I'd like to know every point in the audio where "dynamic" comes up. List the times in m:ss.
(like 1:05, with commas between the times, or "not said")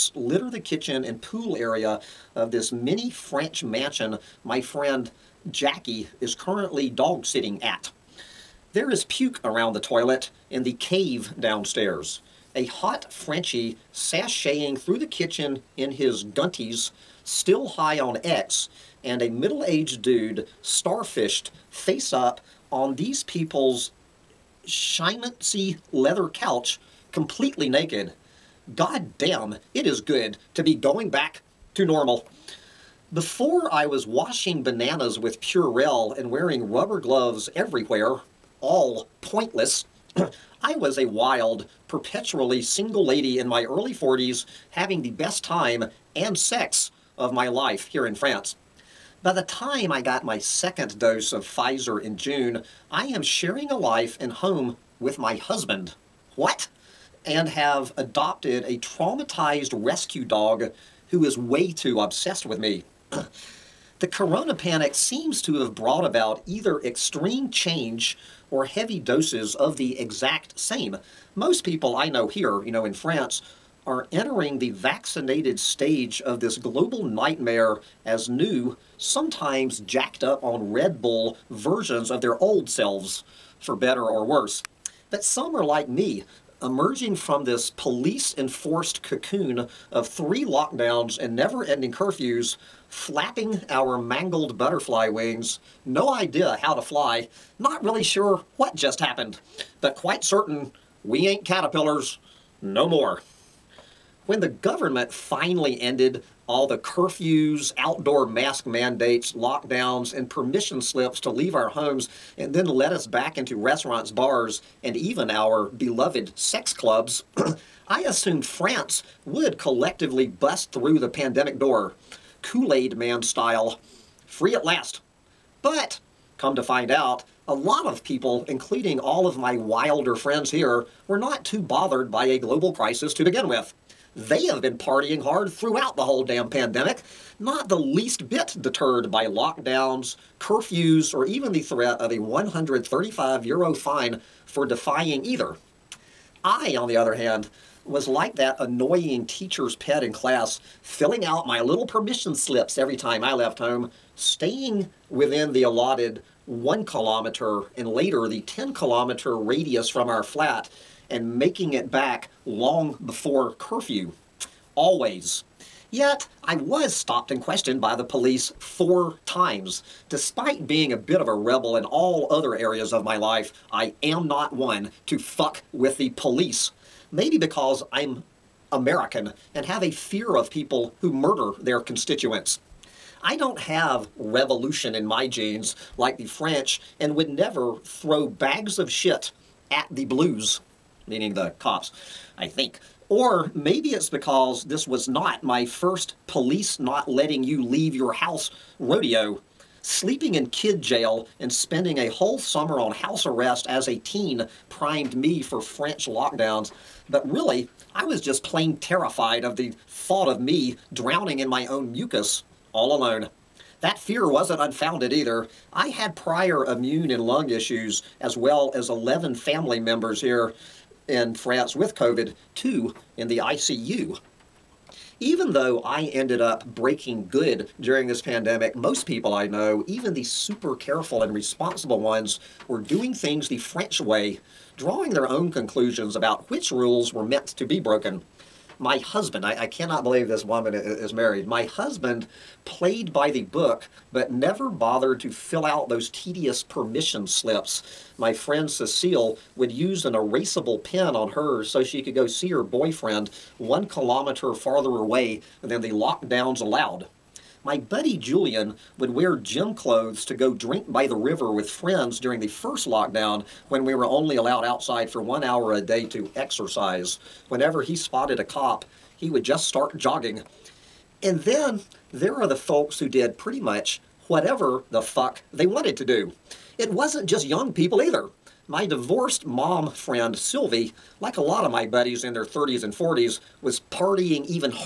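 not said.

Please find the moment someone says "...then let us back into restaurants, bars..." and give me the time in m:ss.
1:52.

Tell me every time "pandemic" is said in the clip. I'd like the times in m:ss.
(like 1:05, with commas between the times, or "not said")
2:01, 2:16, 3:48.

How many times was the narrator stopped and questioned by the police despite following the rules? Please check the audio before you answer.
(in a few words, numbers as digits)
4.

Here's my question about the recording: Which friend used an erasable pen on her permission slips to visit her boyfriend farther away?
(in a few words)
Cecile.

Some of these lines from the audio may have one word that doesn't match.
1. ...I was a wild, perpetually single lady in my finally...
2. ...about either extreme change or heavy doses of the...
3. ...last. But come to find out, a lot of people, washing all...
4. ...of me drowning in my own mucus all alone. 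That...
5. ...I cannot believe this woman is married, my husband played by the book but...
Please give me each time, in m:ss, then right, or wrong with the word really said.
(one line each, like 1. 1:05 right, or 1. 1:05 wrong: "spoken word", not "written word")
1. 0:40 wrong: "early", not "finally"
2. 1:06 right
3. 2:04 wrong: "including", not "washing"
4. 3:30 right
5. 3:59 right.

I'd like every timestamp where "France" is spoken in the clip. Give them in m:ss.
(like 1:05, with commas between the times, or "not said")
0:48, 1:12, 1:58, 3:41.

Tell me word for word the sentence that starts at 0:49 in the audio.
By the time I got my second dose of Pfizer in June, I am sharing a life and home with my husband.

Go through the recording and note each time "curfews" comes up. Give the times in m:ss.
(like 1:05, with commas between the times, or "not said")
1:31, 1:46, 2:20, 2:43.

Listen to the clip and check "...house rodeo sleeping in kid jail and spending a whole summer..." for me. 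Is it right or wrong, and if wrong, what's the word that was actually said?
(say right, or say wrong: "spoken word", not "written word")
right.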